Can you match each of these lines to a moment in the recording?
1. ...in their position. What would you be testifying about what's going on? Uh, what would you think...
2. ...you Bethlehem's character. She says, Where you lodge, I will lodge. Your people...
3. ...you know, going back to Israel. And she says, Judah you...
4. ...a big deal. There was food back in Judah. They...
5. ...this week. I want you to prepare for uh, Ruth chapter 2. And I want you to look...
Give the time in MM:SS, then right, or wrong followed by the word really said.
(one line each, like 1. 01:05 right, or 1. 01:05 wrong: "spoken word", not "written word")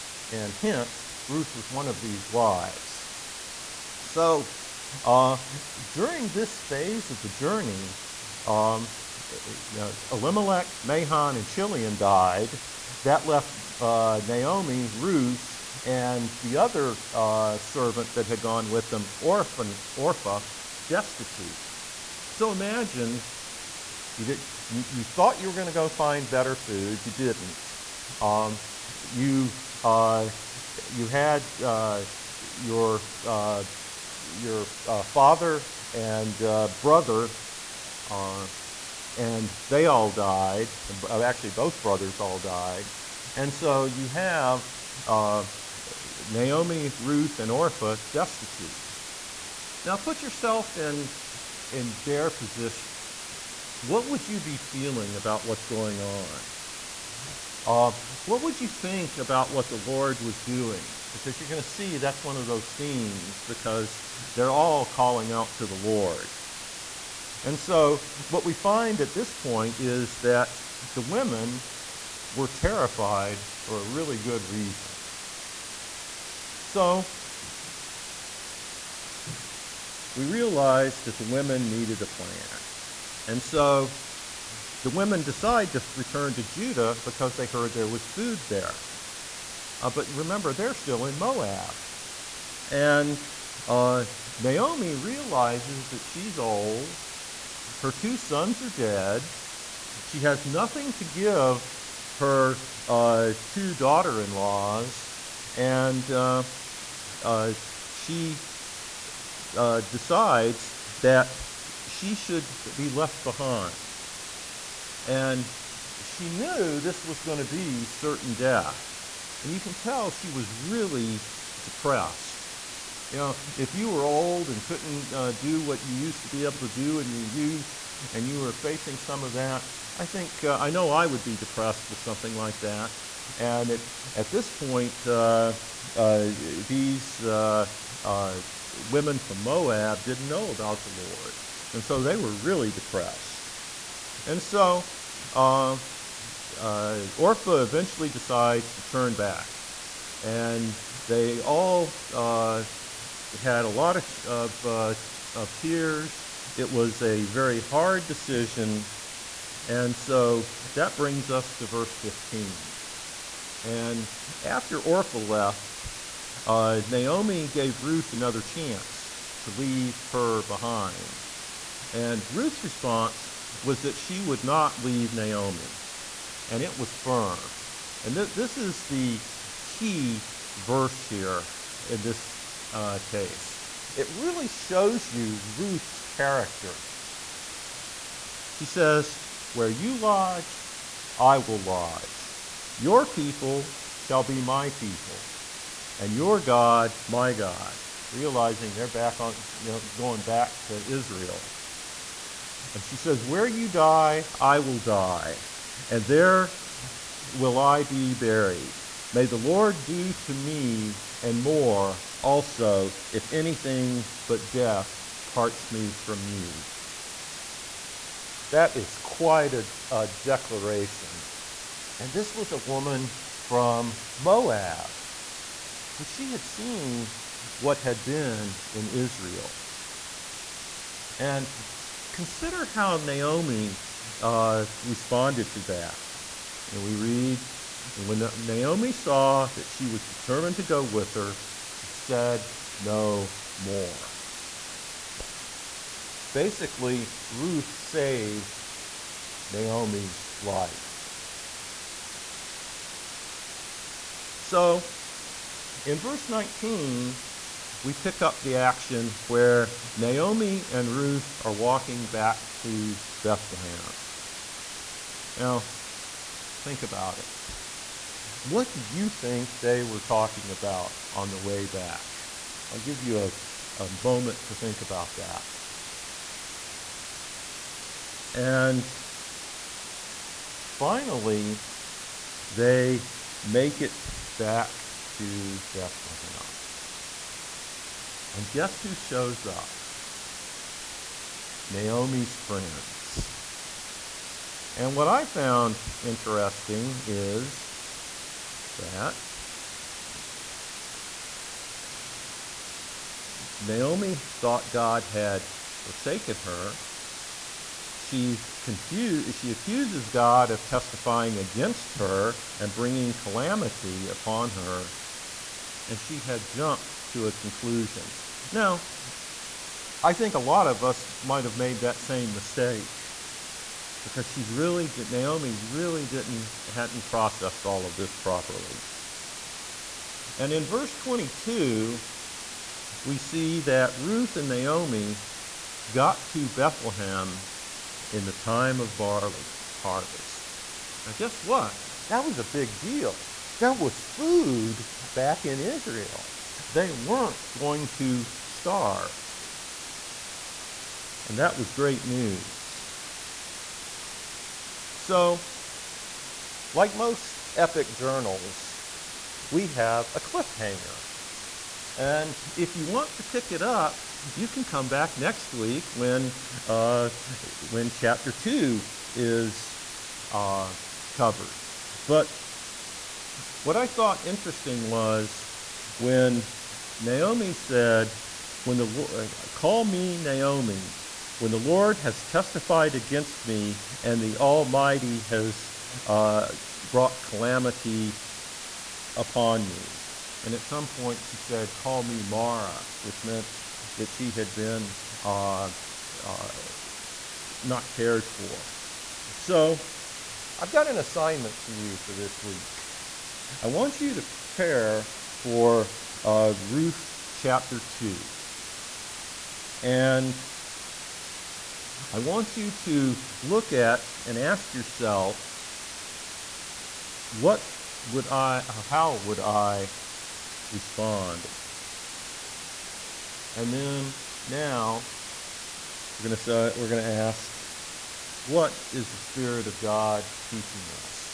1. 00:51 wrong: "feeling", not "testifying"
2. 03:05 wrong: "Ruth", not "Bethlehem"
3. 03:19 wrong: "Where", not "Judah"
4. 05:42 wrong: "Israel", not "Judah"
5. 06:42 right.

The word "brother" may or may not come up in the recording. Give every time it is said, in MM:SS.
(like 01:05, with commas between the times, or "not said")
00:36, 00:41.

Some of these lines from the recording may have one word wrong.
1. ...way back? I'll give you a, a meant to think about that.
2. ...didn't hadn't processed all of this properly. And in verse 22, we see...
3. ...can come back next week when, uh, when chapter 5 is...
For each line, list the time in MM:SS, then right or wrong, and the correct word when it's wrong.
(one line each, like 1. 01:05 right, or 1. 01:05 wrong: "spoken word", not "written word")
1. 04:31 wrong: "moment", not "meant"
2. 05:26 right
3. 06:04 wrong: "2", not "5".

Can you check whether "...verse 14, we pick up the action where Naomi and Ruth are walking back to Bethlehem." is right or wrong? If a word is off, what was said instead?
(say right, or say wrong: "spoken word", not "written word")
wrong: "19", not "14".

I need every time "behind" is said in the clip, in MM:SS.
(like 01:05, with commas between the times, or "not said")
01:53, 02:50.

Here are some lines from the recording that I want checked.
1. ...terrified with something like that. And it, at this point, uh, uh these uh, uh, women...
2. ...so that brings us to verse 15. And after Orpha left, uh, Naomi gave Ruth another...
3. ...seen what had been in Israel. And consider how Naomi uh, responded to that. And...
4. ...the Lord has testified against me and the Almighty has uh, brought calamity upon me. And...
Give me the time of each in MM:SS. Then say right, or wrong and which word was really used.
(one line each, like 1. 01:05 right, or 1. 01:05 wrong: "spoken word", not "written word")
1. 02:11 wrong: "depressed", not "terrified"
2. 02:39 right
3. 03:46 right
4. 06:21 right.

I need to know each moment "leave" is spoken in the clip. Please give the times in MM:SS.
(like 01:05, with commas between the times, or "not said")
02:49, 02:54.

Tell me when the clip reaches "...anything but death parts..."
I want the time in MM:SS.
03:33.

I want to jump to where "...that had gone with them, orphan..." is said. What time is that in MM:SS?
00:18.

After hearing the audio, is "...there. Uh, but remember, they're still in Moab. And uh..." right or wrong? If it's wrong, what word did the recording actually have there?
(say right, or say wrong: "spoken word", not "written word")
right.